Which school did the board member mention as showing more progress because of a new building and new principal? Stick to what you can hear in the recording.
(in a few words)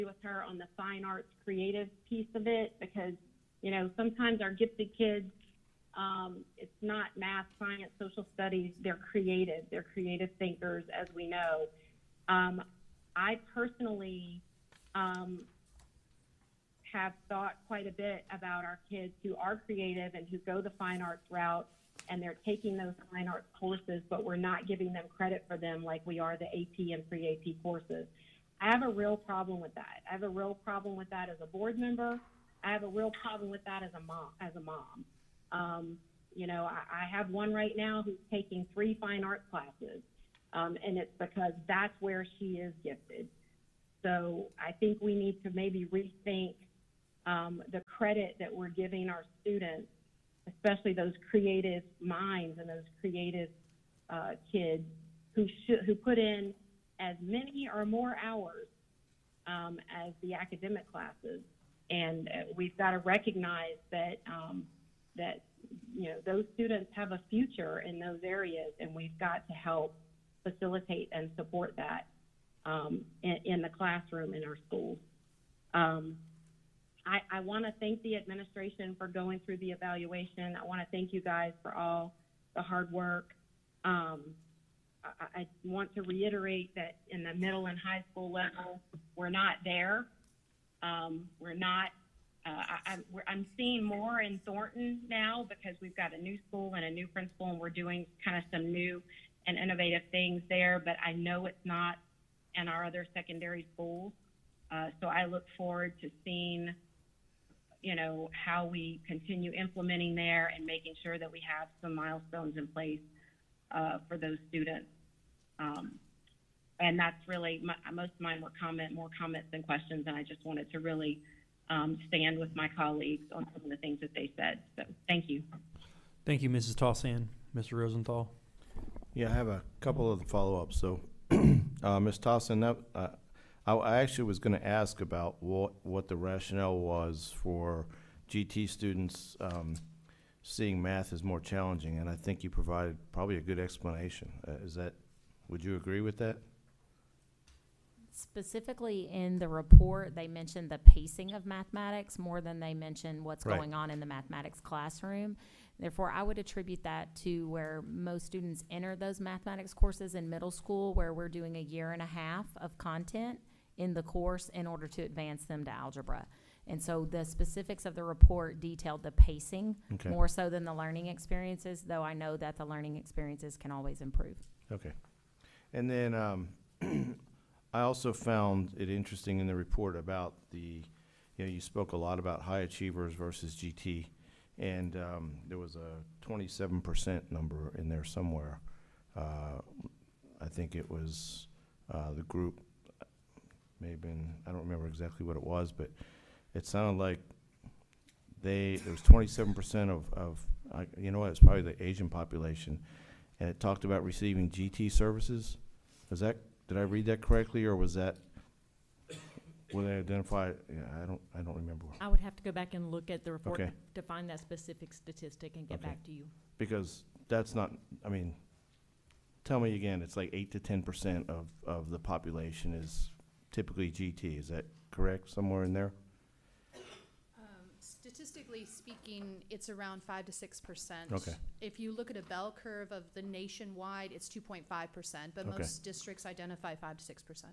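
Thornton.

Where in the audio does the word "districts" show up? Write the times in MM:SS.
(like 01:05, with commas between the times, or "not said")
03:55.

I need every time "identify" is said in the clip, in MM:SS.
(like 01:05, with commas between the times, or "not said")
03:29, 03:56.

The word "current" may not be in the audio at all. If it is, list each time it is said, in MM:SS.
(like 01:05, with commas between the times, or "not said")
not said.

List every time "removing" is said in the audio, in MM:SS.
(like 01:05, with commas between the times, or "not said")
not said.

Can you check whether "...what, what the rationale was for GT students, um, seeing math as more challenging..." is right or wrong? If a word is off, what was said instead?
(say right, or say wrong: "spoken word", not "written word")
right.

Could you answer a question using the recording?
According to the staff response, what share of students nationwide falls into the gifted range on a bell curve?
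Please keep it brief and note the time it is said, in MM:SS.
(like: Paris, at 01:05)
2.5%, at 03:54.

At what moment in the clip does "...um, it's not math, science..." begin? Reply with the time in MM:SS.
00:05.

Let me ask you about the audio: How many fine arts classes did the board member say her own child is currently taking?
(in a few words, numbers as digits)
3.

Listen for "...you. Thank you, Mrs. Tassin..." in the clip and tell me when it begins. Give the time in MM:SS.
02:05.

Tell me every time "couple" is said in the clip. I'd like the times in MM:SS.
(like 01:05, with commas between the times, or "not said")
02:09.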